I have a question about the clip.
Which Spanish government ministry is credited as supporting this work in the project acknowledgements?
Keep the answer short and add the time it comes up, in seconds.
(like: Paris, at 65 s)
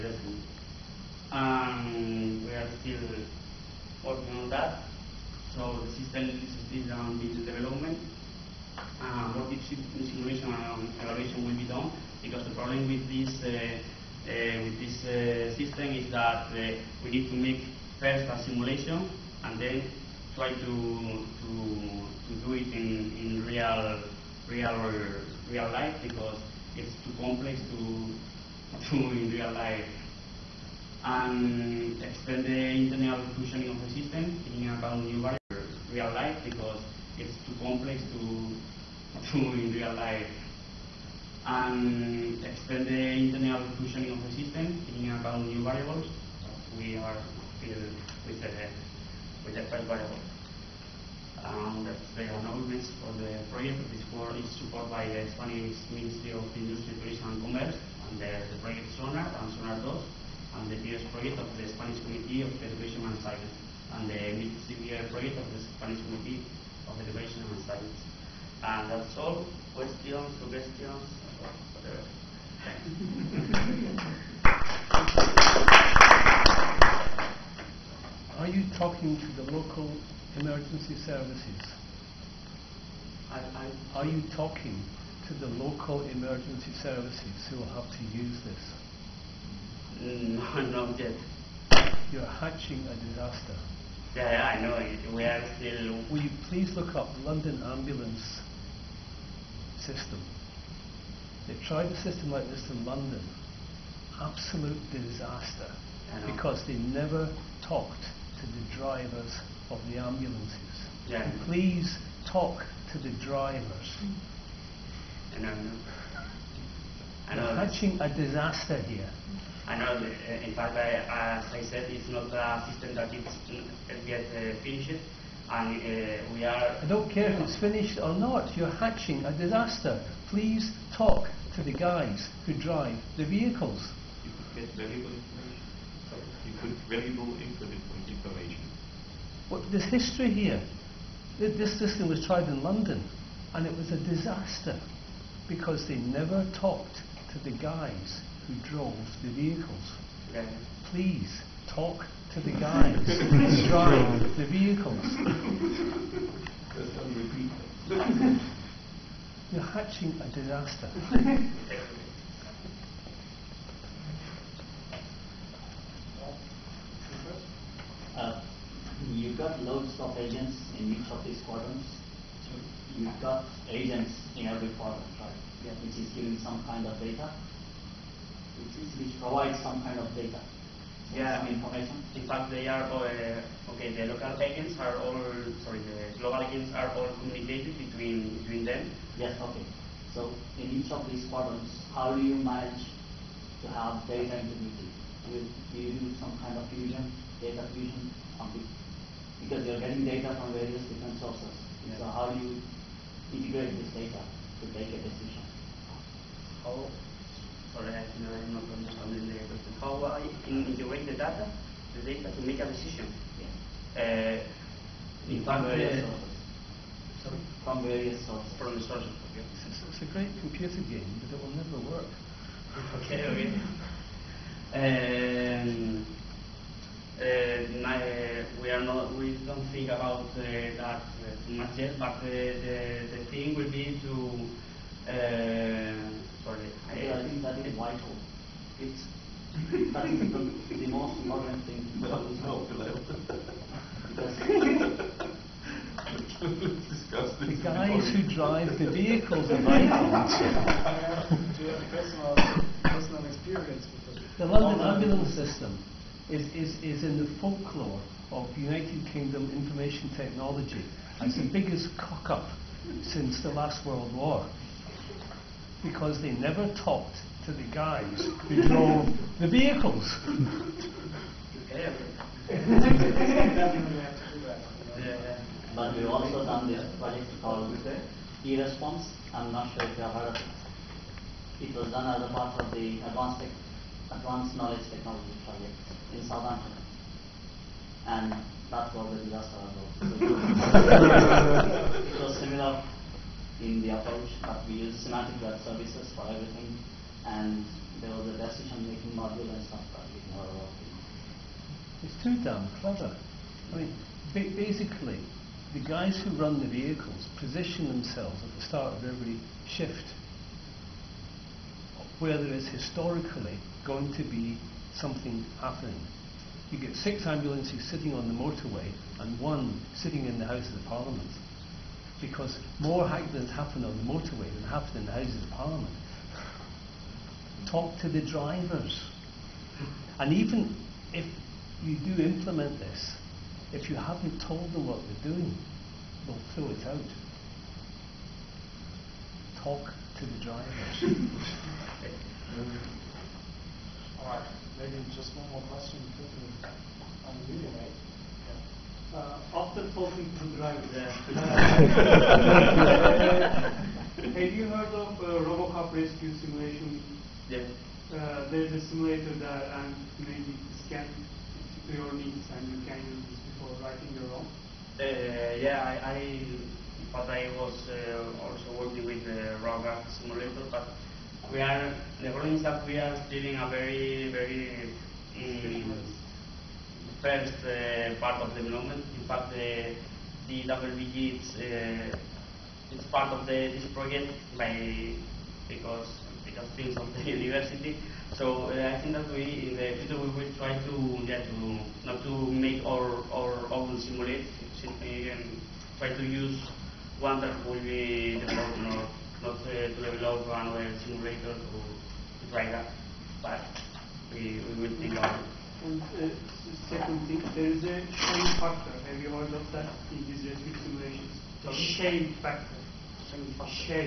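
Ministry of Industry, Tourism and Commerce, at 55 s.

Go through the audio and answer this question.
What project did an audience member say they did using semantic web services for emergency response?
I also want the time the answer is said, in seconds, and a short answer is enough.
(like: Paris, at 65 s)
e-response, at 278 s.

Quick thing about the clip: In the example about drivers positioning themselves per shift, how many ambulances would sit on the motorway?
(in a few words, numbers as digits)
6.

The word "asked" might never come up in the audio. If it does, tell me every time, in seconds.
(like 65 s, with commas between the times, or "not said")
not said.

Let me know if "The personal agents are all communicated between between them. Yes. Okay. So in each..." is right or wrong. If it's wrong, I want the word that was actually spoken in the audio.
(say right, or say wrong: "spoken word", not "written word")
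wrong: "global", not "personal".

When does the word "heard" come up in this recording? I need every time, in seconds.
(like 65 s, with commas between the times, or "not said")
280 s, 354 s, 409 s.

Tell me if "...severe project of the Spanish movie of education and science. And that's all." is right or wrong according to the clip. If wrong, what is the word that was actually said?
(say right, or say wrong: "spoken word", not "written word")
right.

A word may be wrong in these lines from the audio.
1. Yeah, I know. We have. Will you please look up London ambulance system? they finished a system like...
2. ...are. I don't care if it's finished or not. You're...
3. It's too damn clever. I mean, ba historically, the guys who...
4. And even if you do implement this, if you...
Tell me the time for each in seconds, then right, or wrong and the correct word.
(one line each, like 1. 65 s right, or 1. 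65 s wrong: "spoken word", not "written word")
1. 94 s wrong: "tried", not "finished"
2. 126 s right
3. 302 s wrong: "basically", not "historically"
4. 330 s right.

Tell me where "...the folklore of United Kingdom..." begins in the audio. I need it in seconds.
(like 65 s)
257 s.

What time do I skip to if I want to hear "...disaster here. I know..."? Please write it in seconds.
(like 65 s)
118 s.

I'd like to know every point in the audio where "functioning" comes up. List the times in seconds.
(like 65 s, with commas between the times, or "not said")
33 s, 43 s.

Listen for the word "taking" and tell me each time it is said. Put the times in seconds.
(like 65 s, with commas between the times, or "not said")
34 s, 44 s.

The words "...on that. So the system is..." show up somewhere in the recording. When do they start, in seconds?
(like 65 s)
4 s.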